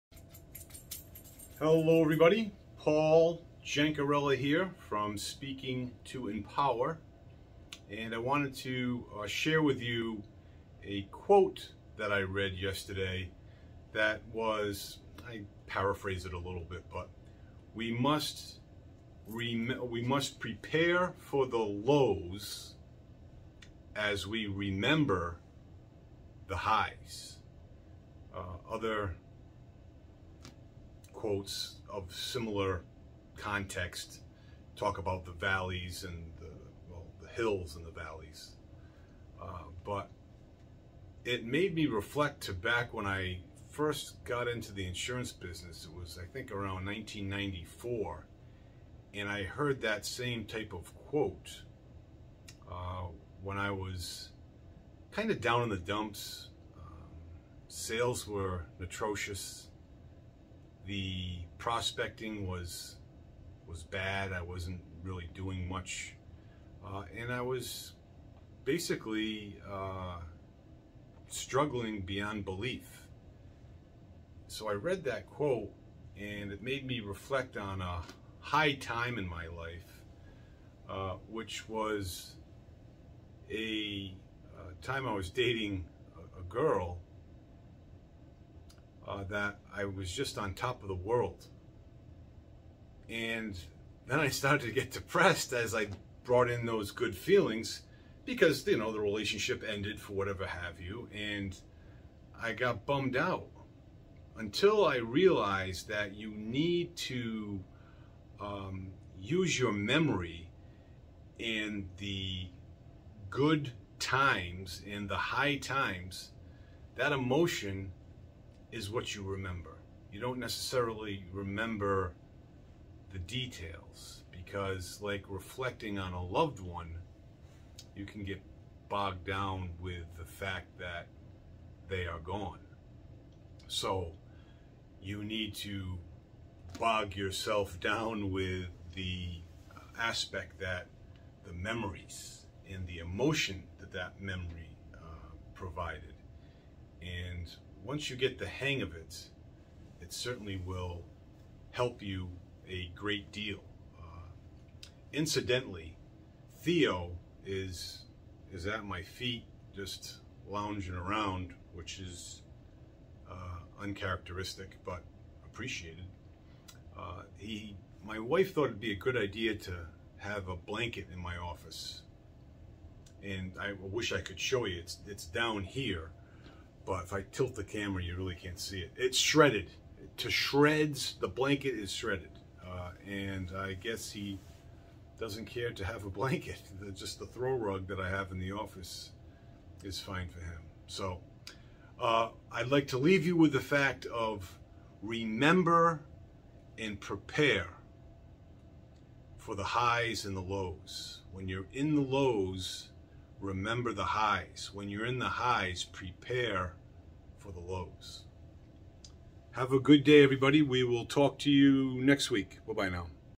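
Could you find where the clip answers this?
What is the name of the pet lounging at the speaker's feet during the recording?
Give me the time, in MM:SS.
02:36.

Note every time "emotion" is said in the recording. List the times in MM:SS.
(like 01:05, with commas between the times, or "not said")
01:57, 02:22.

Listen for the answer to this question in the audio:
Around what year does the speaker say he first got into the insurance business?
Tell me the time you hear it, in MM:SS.
00:46.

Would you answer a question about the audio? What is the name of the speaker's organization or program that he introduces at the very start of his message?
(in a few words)
Speaking to Empower.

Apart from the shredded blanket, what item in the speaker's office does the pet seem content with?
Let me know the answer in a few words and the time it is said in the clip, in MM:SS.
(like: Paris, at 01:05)
throw rug, at 03:07.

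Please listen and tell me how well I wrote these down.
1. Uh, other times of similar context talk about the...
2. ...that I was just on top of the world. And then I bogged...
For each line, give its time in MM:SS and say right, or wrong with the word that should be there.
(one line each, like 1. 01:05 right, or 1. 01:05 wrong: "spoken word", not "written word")
1. 00:28 wrong: "quotes", not "times"
2. 01:29 wrong: "started", not "bogged".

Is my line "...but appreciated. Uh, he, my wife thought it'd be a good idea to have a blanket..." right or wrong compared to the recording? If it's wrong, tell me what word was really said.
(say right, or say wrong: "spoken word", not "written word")
right.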